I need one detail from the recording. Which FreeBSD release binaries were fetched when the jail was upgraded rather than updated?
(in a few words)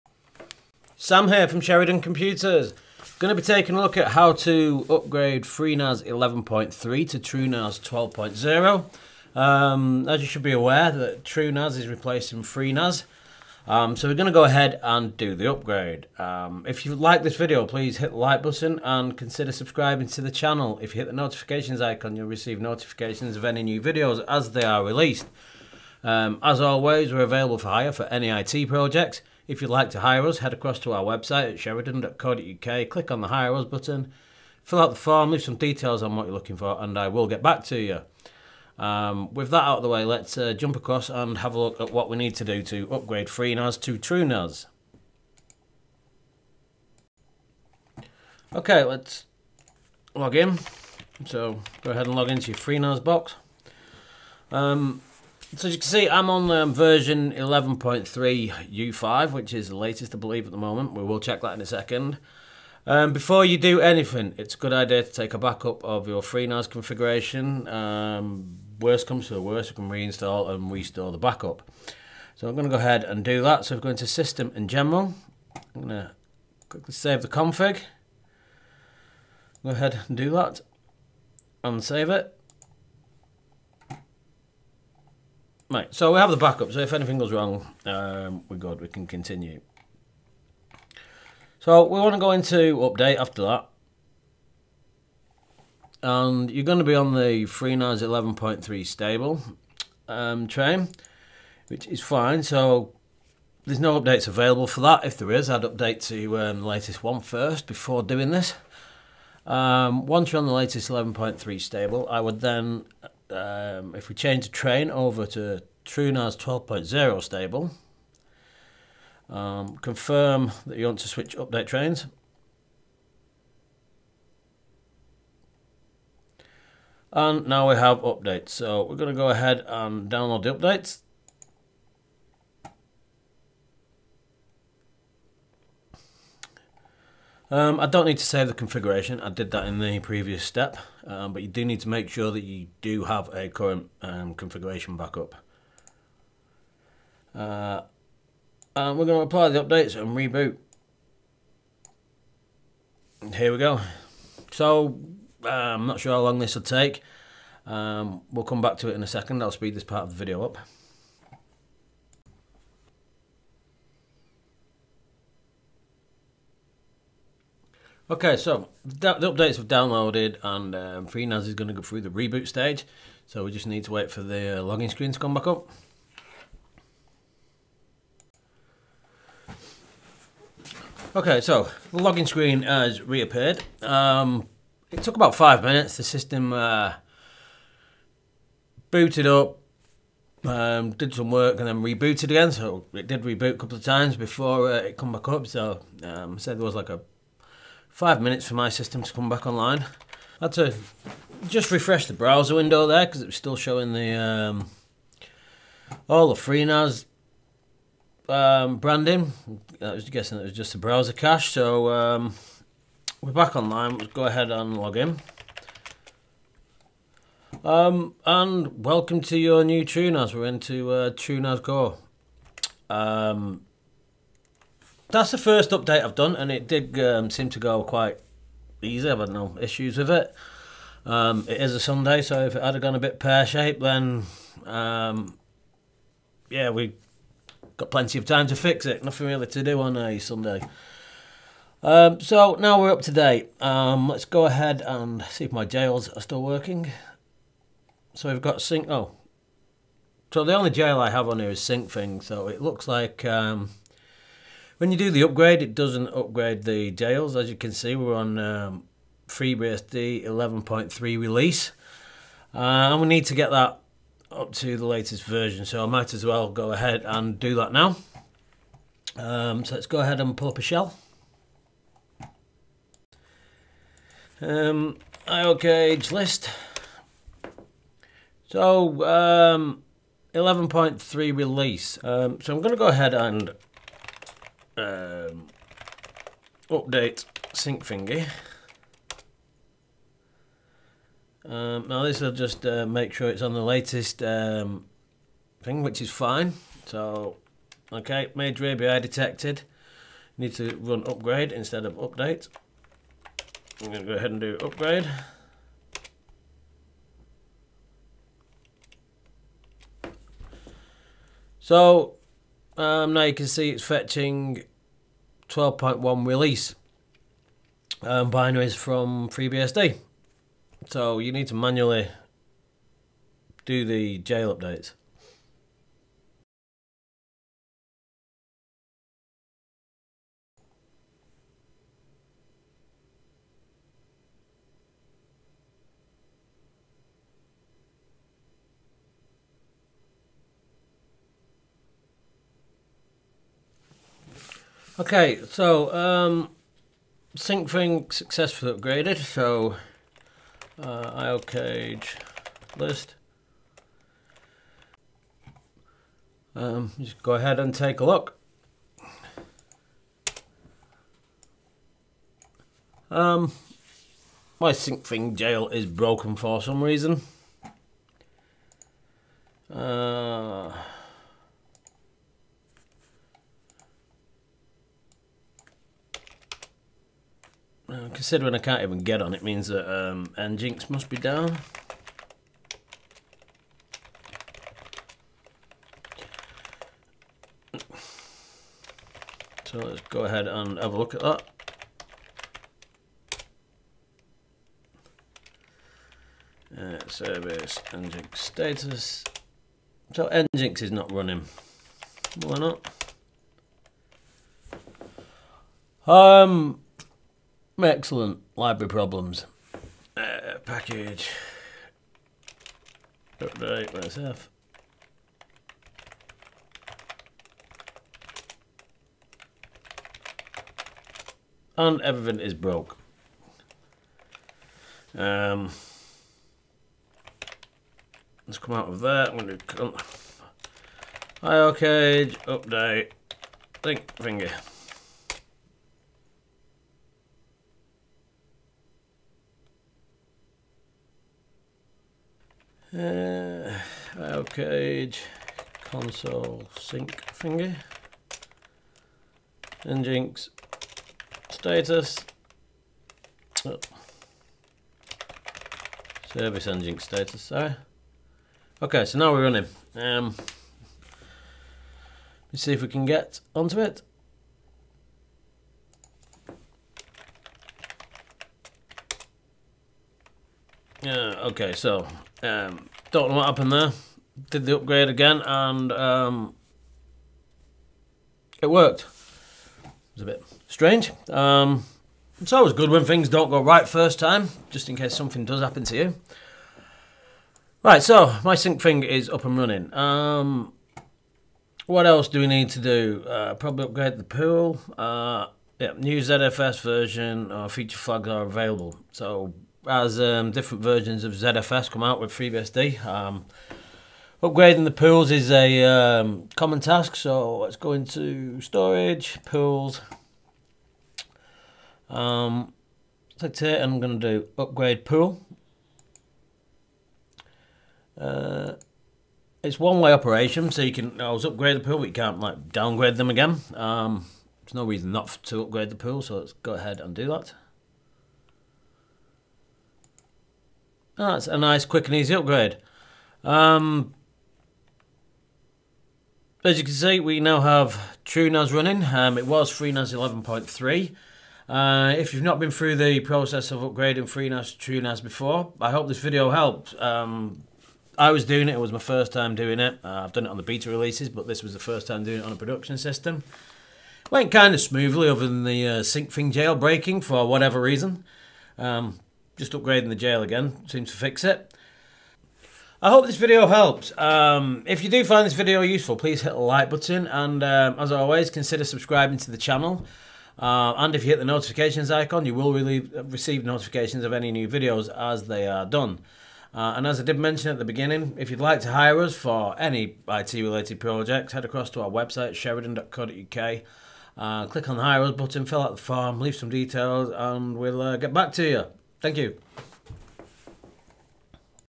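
12.1 release.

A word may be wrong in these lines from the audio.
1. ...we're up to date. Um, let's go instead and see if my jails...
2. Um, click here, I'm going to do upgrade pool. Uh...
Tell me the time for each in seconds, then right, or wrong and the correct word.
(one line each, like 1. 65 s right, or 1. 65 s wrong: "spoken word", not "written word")
1. 242 s wrong: "ahead", not "instead"
2. 512 s right.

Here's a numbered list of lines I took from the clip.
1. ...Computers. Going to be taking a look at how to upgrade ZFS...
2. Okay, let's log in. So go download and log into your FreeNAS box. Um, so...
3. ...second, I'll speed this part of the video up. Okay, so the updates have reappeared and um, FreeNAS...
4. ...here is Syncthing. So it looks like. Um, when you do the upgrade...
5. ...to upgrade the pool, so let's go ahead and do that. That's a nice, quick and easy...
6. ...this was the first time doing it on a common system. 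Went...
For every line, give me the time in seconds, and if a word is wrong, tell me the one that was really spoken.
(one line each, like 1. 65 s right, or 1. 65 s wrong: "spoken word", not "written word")
1. 2 s wrong: "FreeNAS", not "ZFS"
2. 48 s wrong: "ahead", not "download"
3. 159 s wrong: "downloaded", not "reappeared"
4. 251 s right
5. 525 s right
6. 551 s wrong: "production", not "common".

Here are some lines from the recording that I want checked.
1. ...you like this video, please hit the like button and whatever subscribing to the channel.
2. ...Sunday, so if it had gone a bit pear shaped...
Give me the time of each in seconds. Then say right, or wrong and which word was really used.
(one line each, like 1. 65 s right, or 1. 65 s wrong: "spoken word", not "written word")
1. 16 s wrong: "consider", not "whatever"
2. 231 s right.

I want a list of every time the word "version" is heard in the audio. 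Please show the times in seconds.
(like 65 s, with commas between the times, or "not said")
56 s, 265 s, 496 s, 500 s.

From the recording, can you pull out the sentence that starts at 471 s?
Yeah, uh, okay, so um, don't know what happened there.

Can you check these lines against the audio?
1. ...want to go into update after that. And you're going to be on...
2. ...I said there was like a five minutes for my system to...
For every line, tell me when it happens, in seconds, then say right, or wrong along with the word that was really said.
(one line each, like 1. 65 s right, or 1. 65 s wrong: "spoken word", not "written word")
1. 92 s right
2. 196 s right.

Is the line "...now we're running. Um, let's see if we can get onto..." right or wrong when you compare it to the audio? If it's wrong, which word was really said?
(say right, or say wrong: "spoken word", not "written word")
right.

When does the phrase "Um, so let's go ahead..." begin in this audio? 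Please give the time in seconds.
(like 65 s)
269 s.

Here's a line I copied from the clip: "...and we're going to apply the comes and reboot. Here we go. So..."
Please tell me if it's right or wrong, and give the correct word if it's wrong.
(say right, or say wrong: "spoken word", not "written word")
wrong: "updates", not "comes".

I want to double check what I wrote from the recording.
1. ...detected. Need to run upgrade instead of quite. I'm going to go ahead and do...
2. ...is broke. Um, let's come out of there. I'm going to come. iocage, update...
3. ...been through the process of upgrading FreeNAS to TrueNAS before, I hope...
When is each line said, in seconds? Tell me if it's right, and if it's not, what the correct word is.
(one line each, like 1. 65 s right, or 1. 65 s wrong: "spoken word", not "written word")
1. 299 s wrong: "update", not "quite"
2. 422 s right
3. 542 s right.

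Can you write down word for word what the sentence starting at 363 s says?
Um, my Syncthing jail is broken for some reason.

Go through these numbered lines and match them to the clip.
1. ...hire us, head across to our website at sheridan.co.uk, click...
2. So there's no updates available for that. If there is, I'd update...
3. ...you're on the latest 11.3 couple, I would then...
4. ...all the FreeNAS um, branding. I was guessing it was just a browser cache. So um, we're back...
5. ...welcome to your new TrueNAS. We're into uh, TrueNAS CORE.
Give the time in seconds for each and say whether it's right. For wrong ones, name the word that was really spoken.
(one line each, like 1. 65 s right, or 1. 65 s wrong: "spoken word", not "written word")
1. 30 s right
2. 102 s right
3. 110 s wrong: "stable", not "couple"
4. 206 s right
5. 218 s right.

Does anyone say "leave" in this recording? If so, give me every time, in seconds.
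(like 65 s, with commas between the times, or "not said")
35 s, 586 s.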